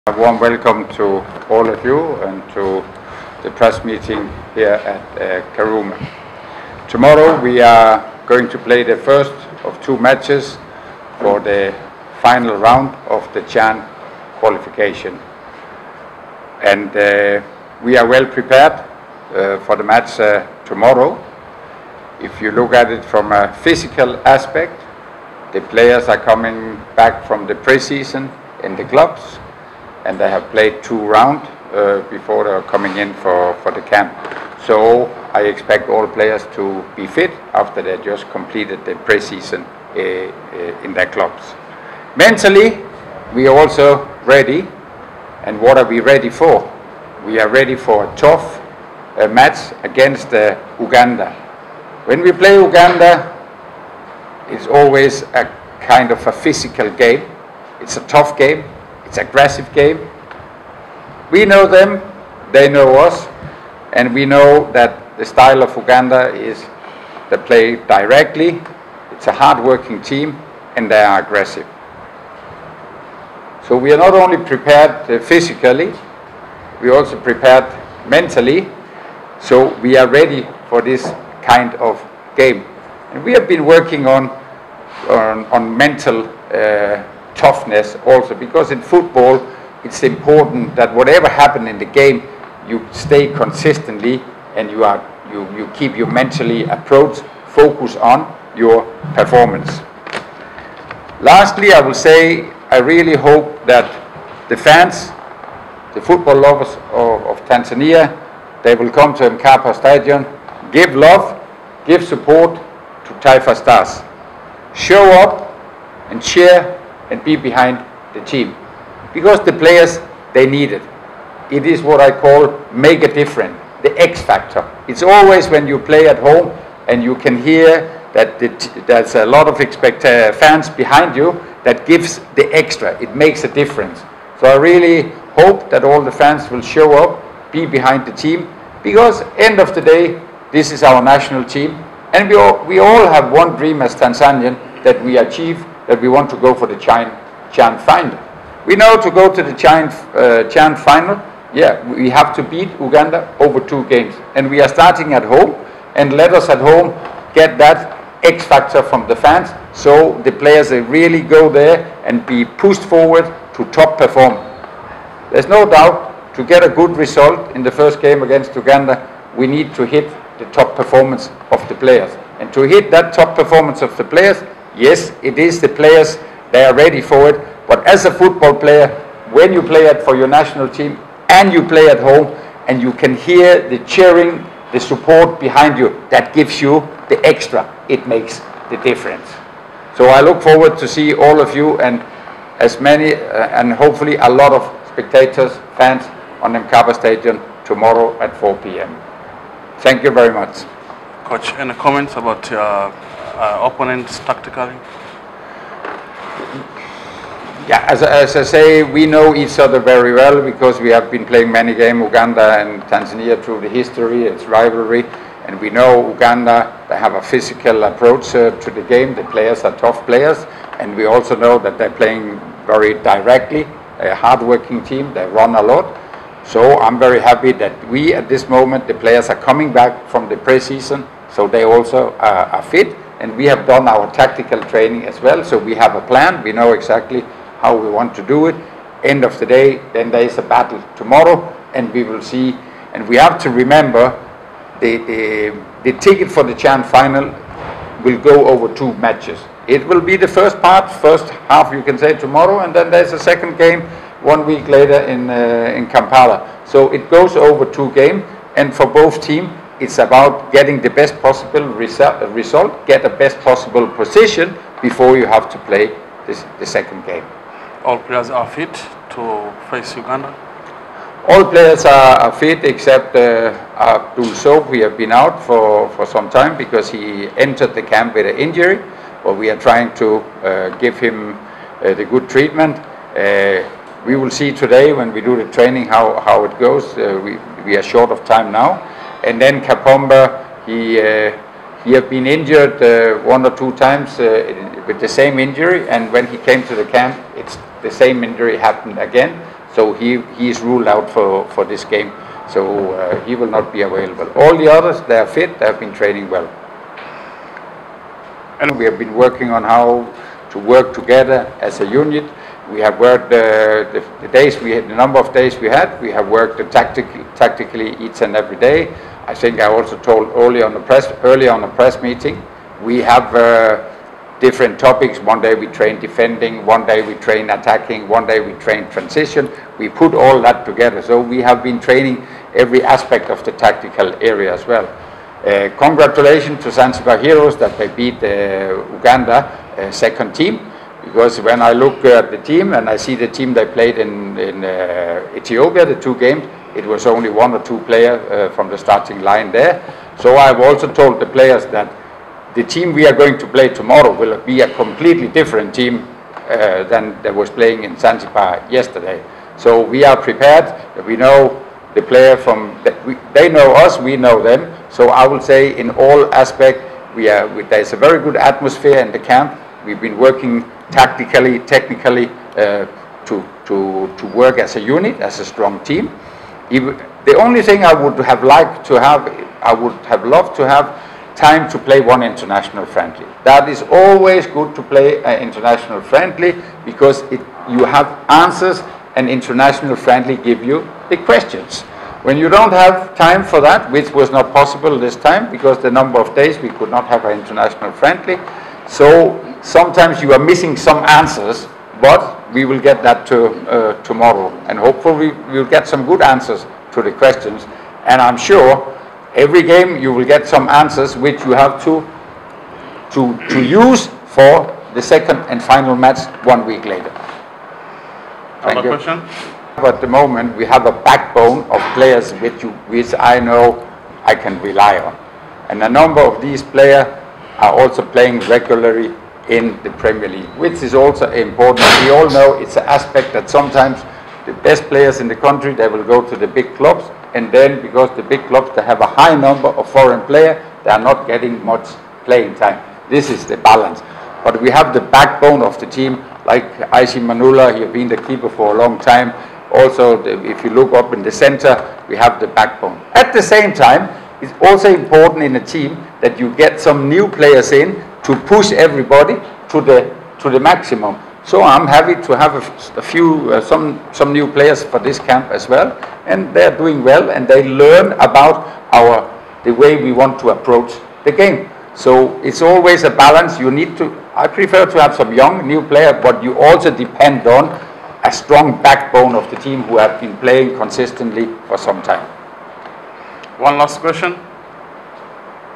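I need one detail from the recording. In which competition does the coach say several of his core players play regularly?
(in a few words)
Premier League.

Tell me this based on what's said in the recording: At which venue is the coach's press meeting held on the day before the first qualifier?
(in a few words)
Karume.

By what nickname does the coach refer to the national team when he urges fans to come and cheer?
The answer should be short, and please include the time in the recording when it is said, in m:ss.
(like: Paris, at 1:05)
Taifa Stars, at 1:53.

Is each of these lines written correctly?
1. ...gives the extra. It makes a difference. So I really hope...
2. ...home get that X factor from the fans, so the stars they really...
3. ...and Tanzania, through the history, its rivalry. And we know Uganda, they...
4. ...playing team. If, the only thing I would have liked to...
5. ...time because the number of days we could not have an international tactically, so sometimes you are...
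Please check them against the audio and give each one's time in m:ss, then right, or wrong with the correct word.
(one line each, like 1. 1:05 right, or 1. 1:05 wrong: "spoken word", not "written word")
1. 2:11 right
2. 2:36 wrong: "players", not "stars"
3. 3:32 right
4. 6:15 wrong: "strong", not "playing"
5. 6:35 wrong: "friendly", not "tactically".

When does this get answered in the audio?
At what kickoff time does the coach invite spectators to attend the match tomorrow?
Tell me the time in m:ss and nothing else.
3:18.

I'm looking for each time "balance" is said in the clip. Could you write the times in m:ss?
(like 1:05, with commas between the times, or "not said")
7:23, 7:53.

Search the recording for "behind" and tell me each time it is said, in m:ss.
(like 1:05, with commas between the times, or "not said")
1:57, 2:10, 2:17, 3:05.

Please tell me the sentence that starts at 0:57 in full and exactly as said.
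It's a tough game it's aggressive game.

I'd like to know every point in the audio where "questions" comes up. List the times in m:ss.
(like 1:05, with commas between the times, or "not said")
6:31, 6:47, 6:58, 8:03.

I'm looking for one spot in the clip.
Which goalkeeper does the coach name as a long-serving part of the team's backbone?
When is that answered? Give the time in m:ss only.
7:26.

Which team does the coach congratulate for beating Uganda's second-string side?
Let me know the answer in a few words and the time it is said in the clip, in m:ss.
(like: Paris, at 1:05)
Zanzibar Heroes, at 5:36.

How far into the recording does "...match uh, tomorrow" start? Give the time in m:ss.
0:19.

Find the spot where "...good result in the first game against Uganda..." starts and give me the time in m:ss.
2:46.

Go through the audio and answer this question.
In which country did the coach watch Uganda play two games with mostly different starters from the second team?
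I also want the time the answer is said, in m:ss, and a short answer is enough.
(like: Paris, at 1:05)
Ethiopia, at 5:45.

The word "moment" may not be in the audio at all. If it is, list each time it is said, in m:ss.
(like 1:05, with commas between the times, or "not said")
3:48, 7:00.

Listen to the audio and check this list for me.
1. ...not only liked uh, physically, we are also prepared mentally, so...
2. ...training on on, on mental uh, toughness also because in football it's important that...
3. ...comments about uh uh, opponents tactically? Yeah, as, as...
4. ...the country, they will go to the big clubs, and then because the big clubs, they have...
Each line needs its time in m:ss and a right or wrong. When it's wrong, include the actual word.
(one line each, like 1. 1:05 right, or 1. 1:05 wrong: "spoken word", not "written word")
1. 1:13 wrong: "prepared", not "liked"
2. 1:23 wrong: "working", not "training"
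3. 3:21 right
4. 7:15 right.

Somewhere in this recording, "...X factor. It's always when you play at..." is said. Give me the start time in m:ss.
2:04.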